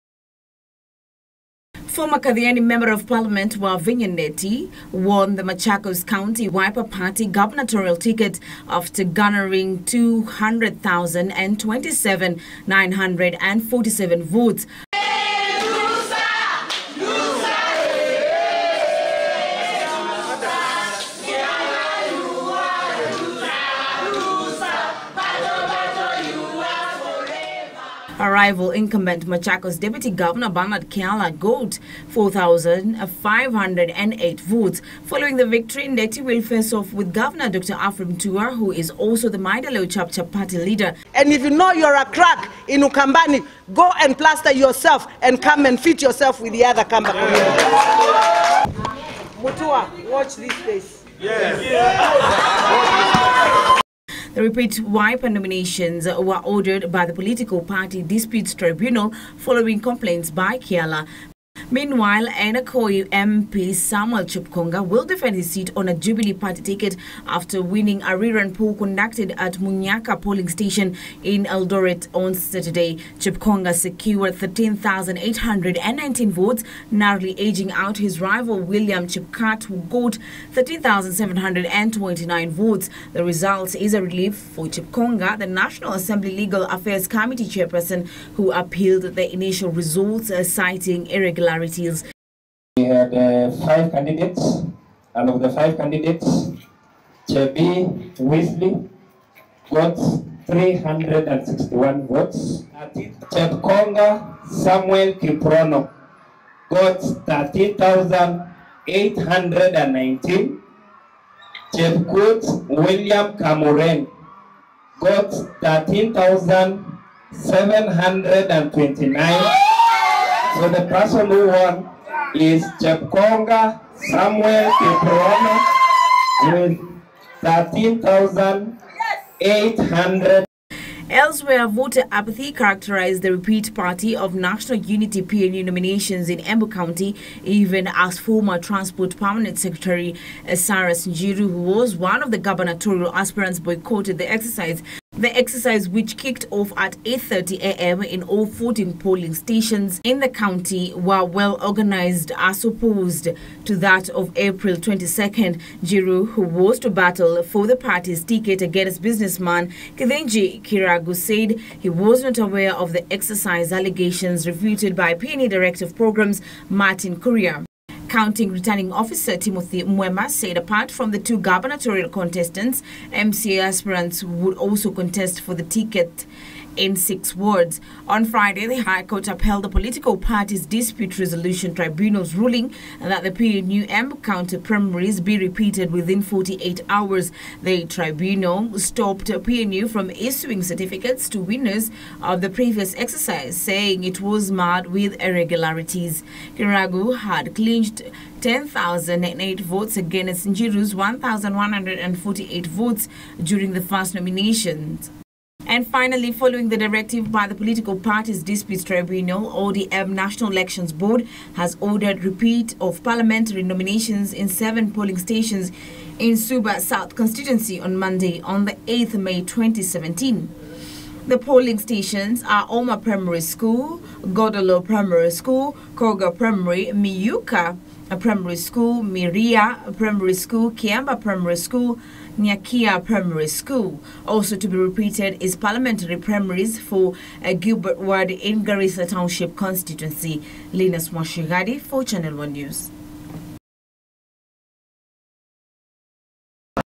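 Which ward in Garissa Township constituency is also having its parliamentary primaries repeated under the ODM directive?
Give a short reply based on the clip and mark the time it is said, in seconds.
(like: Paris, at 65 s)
Galbet, at 237 s.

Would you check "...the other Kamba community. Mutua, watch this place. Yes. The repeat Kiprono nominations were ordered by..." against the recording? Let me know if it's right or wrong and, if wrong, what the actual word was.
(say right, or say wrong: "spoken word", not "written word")
wrong: "Wiper", not "Kiprono".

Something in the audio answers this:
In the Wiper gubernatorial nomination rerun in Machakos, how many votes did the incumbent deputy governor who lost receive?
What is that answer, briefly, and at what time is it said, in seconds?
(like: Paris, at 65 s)
4,508, at 32 s.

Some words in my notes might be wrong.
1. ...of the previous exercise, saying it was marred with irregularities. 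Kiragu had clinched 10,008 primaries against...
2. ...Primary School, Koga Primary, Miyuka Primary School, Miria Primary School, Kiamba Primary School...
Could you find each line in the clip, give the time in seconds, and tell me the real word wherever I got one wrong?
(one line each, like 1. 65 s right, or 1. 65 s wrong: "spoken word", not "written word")
1. 192 s wrong: "votes", not "primaries"
2. 224 s right.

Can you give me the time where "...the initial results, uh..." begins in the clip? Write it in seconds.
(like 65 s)
89 s.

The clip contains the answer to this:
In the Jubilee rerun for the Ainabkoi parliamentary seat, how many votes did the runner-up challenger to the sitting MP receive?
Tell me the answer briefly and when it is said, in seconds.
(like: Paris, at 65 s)
13,819, at 74 s.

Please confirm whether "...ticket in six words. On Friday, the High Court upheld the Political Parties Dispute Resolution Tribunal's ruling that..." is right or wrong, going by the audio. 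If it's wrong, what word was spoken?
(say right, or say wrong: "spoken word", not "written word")
right.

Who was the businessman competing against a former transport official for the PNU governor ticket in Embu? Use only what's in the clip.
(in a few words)
Kithinji Kiragu.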